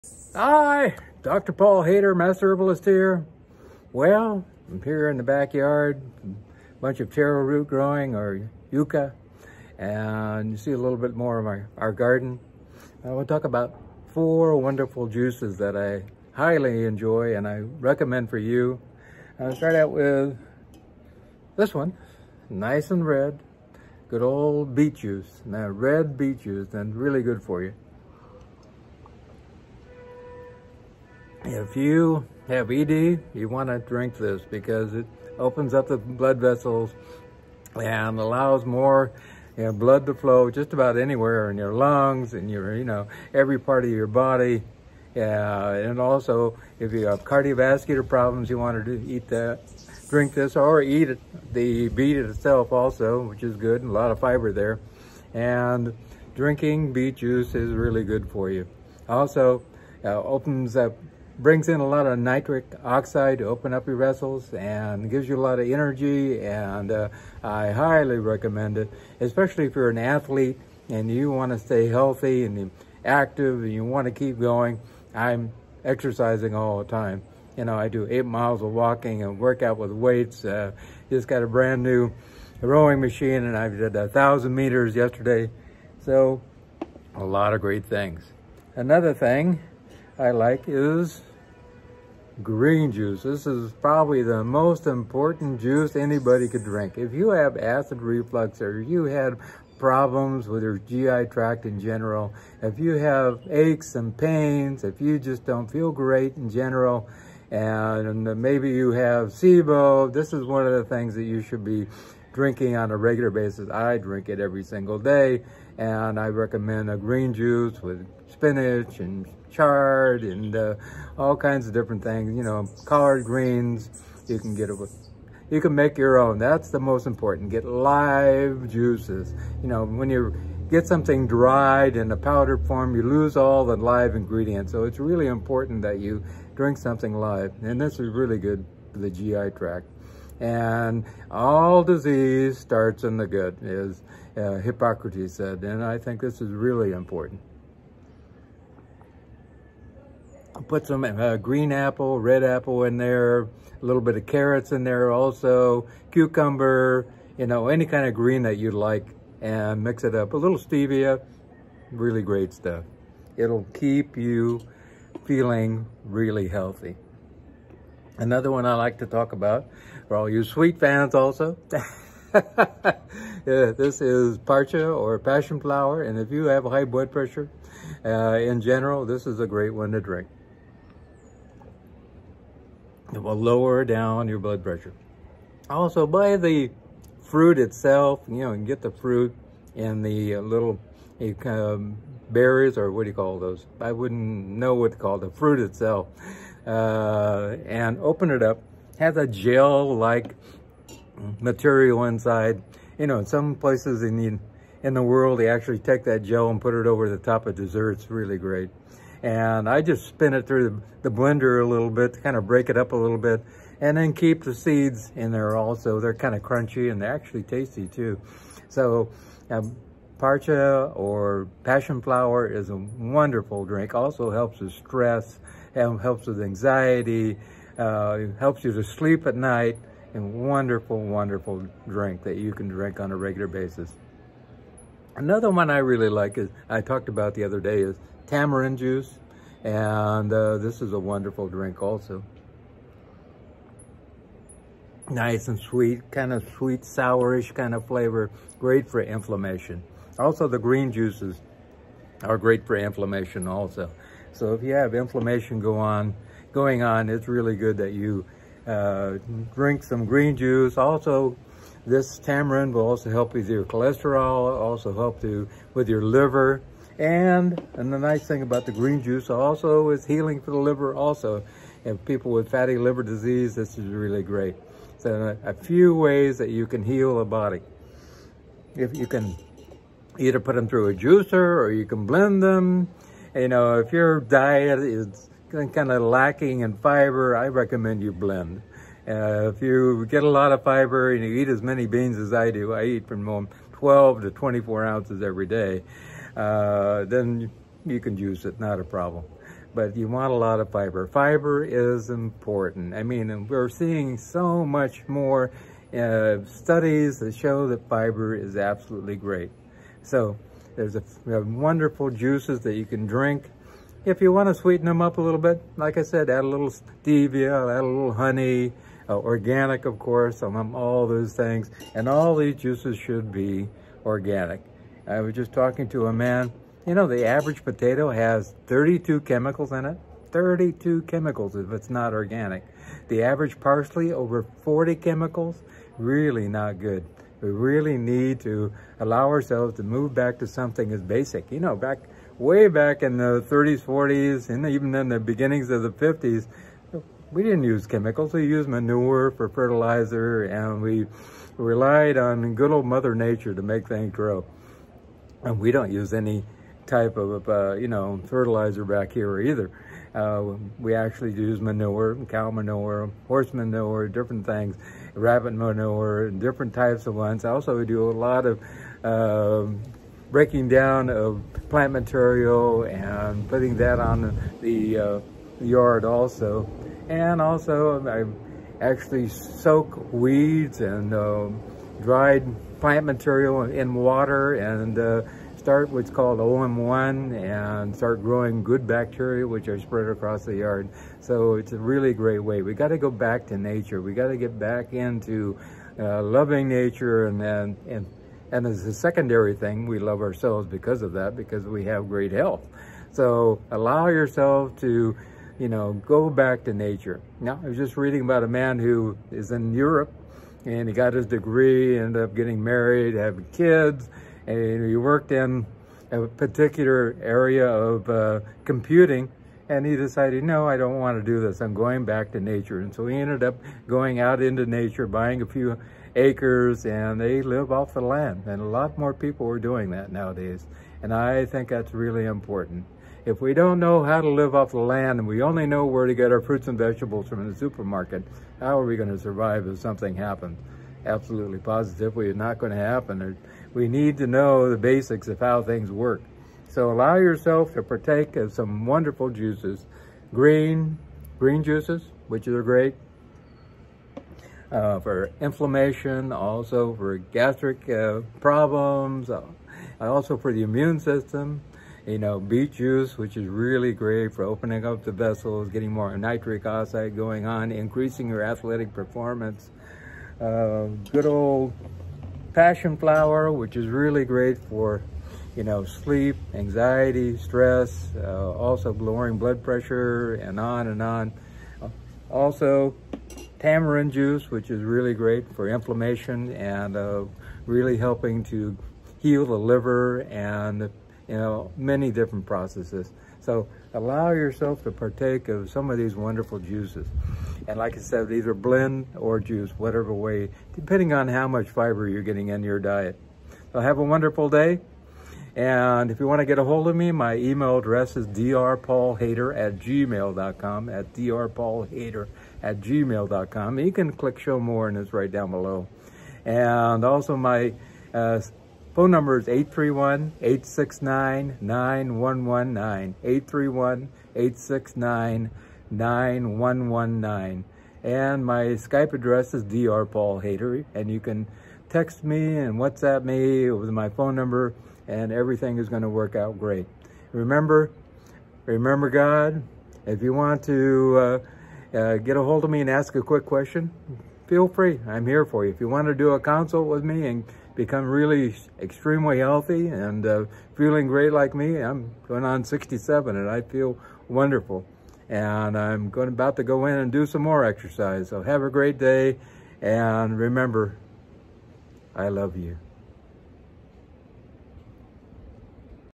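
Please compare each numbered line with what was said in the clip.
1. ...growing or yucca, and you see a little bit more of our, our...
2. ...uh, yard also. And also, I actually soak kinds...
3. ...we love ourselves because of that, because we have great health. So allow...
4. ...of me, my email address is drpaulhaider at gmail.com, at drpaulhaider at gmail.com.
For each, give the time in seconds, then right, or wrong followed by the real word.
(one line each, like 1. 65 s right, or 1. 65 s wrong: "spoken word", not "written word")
1. 7 s right
2. 374 s wrong: "weeds", not "kinds"
3. 399 s right
4. 506 s right.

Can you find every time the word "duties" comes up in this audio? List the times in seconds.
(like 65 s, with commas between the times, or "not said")
not said.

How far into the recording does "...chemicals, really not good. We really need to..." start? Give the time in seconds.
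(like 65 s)
334 s.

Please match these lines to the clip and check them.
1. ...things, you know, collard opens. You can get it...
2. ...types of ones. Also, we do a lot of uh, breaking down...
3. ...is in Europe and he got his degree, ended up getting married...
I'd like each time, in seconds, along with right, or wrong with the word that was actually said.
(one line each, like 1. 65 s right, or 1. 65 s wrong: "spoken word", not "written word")
1. 122 s wrong: "greens", not "opens"
2. 366 s right
3. 409 s right.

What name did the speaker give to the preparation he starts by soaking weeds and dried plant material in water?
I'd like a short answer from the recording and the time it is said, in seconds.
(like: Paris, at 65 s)
OM1, at 386 s.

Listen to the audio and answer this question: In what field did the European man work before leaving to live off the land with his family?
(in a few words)
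computing.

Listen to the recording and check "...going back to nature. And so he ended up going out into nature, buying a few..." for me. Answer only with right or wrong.
right.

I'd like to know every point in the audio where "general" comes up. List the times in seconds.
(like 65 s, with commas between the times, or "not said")
101 s, 106 s, 178 s.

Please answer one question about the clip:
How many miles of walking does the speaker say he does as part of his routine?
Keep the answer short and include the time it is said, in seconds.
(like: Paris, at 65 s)
8, at 78 s.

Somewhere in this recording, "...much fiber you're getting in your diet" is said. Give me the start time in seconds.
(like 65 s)
501 s.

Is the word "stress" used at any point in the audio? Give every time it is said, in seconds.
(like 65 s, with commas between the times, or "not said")
224 s, 477 s.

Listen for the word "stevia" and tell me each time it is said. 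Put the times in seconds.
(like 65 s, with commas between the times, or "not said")
160 s, 316 s.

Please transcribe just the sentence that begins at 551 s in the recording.
I'm going on 67 and I feel wonderful.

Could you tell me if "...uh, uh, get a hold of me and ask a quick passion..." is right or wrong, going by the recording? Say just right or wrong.
wrong.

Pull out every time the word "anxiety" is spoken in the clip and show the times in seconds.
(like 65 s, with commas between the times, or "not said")
226 s, 476 s.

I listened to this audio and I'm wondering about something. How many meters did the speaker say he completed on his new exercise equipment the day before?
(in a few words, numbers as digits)
1000.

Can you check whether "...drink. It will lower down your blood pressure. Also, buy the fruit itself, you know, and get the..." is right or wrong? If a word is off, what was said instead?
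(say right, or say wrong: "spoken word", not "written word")
right.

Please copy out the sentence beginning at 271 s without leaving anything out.
And people with fatty liver disease, this is really great.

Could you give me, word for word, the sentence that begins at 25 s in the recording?
Now red beet juice, and really good for you.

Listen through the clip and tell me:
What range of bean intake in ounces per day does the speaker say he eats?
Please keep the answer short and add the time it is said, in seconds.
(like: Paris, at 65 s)
12 to 24 ounces, at 293 s.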